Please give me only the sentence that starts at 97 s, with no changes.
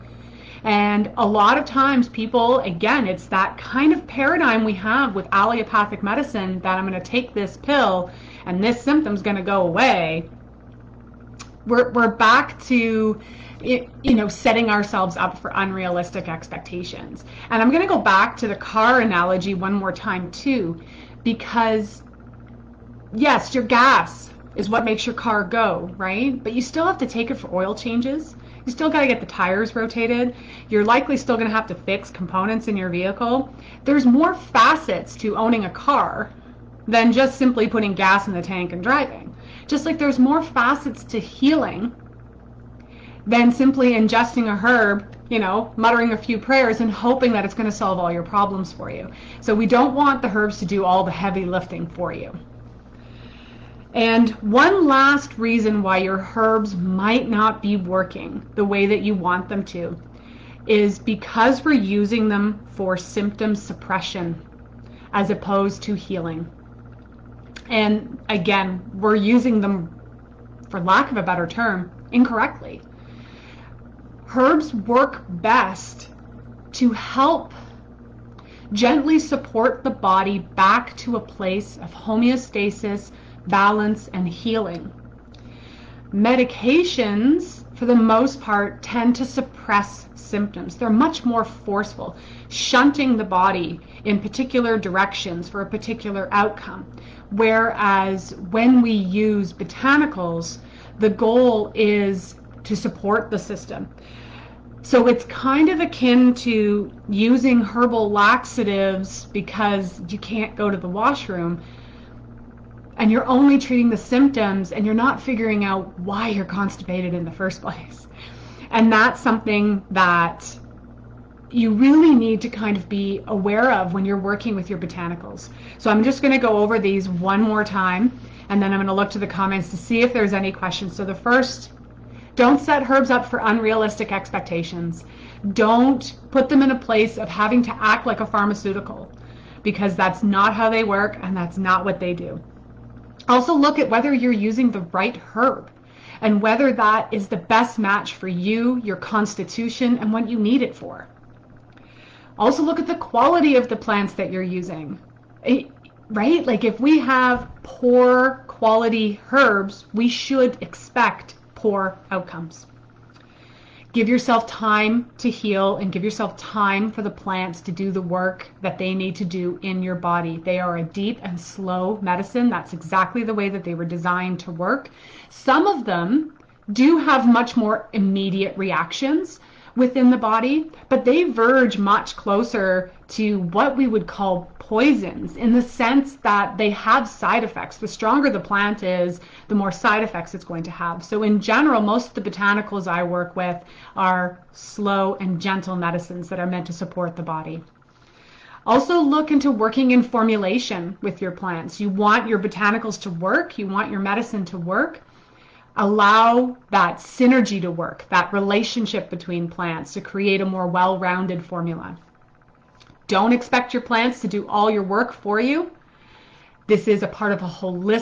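Whereas when we use botanicals, the goal is to support the system.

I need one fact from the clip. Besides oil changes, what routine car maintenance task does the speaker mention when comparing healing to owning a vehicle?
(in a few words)
tires rotated.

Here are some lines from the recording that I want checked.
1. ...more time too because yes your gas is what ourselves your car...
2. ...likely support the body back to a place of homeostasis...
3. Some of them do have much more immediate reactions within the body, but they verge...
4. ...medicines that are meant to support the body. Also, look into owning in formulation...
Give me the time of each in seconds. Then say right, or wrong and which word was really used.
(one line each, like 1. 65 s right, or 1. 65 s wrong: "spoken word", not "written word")
1. 19 s wrong: "makes", not "ourselves"
2. 78 s wrong: "gently", not "likely"
3. 175 s right
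4. 195 s wrong: "working", not "owning".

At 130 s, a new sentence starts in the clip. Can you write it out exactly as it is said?
So the first, don't set herbs up for unrealistic expectations.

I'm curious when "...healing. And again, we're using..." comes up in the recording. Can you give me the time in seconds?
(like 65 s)
65 s.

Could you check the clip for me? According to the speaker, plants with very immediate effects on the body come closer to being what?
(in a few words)
poisons.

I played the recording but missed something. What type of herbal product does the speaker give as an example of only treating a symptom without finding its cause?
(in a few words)
herbal laxatives.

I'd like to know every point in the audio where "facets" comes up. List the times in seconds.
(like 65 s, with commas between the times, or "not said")
34 s, 40 s.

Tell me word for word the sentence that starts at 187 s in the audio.
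The stronger the plant is, the more side effects it's going to have.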